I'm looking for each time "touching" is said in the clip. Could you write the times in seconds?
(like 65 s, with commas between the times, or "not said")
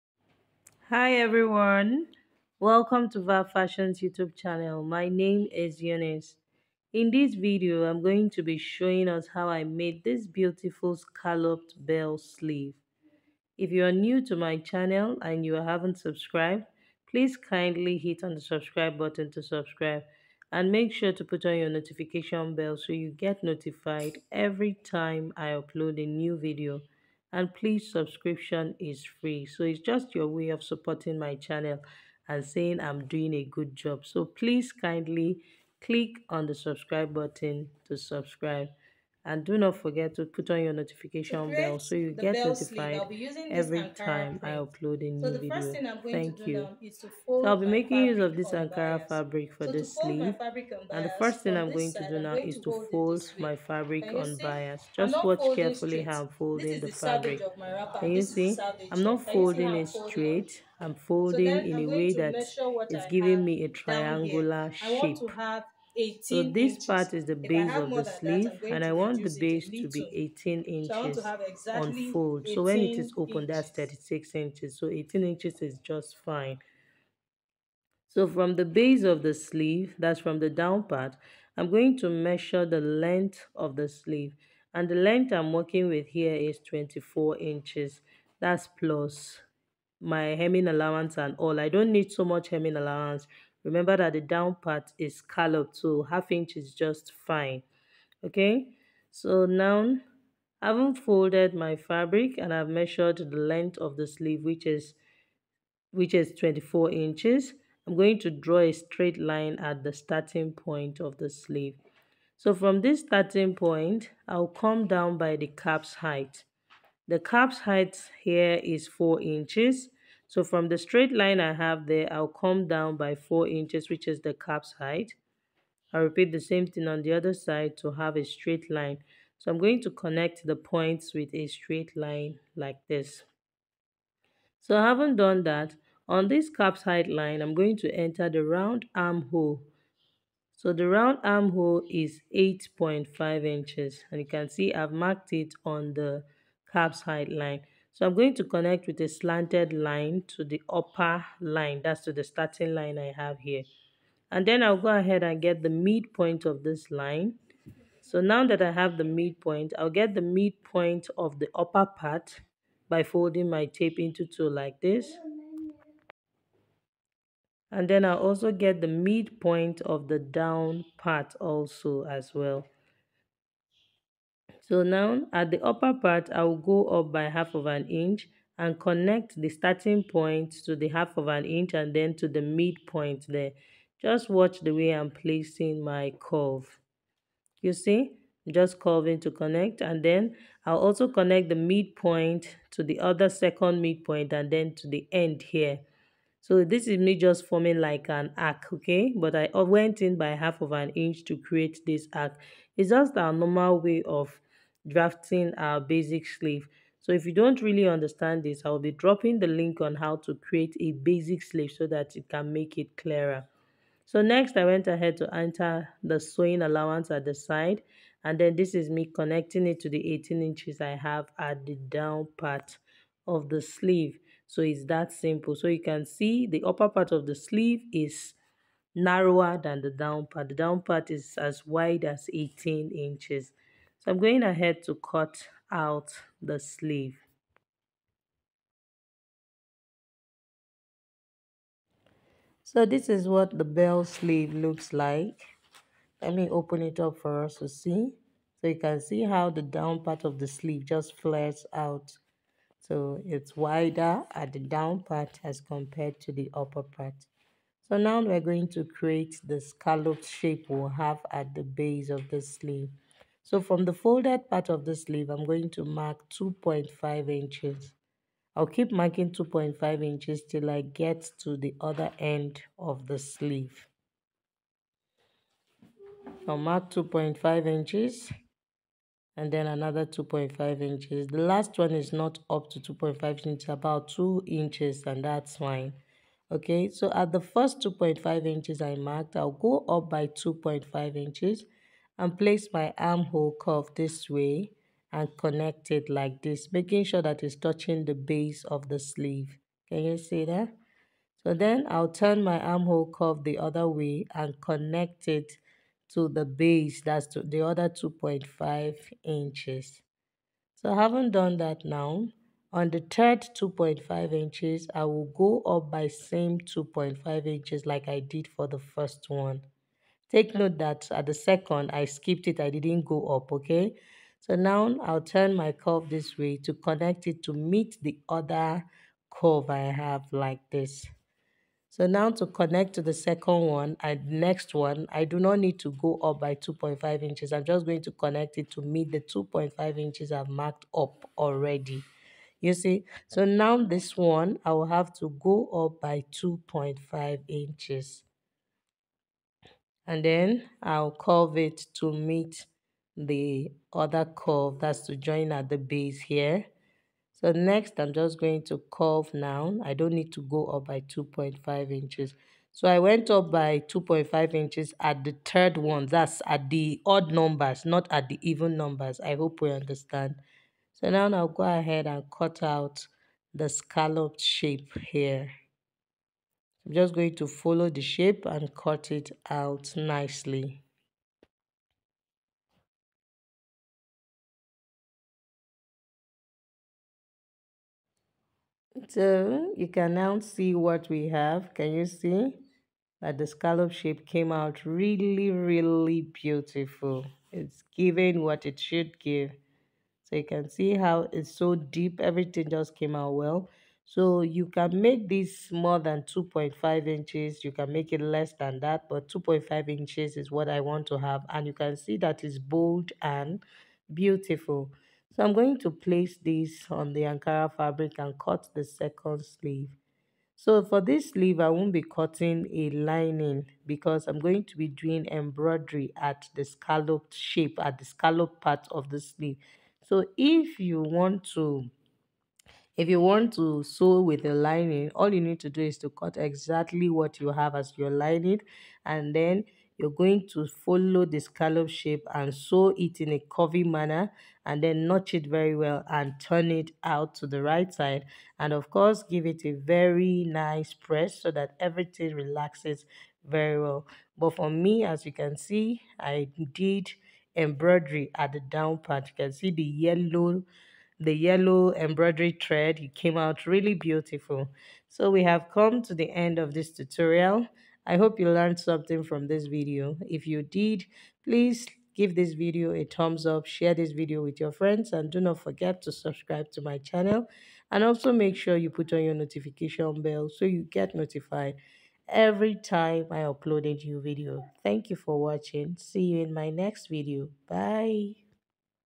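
297 s.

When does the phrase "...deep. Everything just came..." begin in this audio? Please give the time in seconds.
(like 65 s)
401 s.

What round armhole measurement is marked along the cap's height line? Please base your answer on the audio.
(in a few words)
8.5 inches.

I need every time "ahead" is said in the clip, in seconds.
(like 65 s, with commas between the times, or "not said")
154 s, 214 s, 234 s, 371 s.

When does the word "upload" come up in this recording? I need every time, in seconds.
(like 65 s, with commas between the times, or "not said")
25 s, 44 s, 483 s.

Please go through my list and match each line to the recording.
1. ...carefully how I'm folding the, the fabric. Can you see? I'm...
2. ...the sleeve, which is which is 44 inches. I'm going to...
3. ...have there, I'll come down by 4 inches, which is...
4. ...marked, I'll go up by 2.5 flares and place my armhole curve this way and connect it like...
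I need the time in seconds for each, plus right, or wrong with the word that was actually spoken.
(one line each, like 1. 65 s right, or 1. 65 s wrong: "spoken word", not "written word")
1. 55 s right
2. 103 s wrong: "24", not "44"
3. 121 s right
4. 288 s wrong: "inches", not "flares".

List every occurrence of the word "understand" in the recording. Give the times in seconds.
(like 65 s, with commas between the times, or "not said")
207 s, 369 s.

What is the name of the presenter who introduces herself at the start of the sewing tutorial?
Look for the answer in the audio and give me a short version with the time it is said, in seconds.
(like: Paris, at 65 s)
Eunice, at 5 s.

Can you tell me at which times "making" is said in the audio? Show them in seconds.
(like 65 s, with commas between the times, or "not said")
47 s, 296 s.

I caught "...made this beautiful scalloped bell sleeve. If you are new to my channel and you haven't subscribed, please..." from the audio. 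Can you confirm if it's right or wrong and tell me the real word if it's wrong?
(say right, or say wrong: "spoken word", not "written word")
right.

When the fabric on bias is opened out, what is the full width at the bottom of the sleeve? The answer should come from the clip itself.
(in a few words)
36 inches.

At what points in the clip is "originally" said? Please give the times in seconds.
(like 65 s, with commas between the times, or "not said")
not said.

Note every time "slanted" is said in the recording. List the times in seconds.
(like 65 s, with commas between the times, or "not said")
149 s.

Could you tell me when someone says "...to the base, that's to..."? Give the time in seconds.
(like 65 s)
306 s.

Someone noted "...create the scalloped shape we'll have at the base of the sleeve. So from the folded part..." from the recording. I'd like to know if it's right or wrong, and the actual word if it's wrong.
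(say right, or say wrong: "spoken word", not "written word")
right.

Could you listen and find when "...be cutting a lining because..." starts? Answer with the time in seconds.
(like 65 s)
421 s.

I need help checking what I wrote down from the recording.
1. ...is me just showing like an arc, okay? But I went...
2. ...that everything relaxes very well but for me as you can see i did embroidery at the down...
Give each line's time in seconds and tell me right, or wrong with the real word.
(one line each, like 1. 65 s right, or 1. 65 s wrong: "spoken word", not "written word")
1. 196 s wrong: "forming", not "showing"
2. 451 s right.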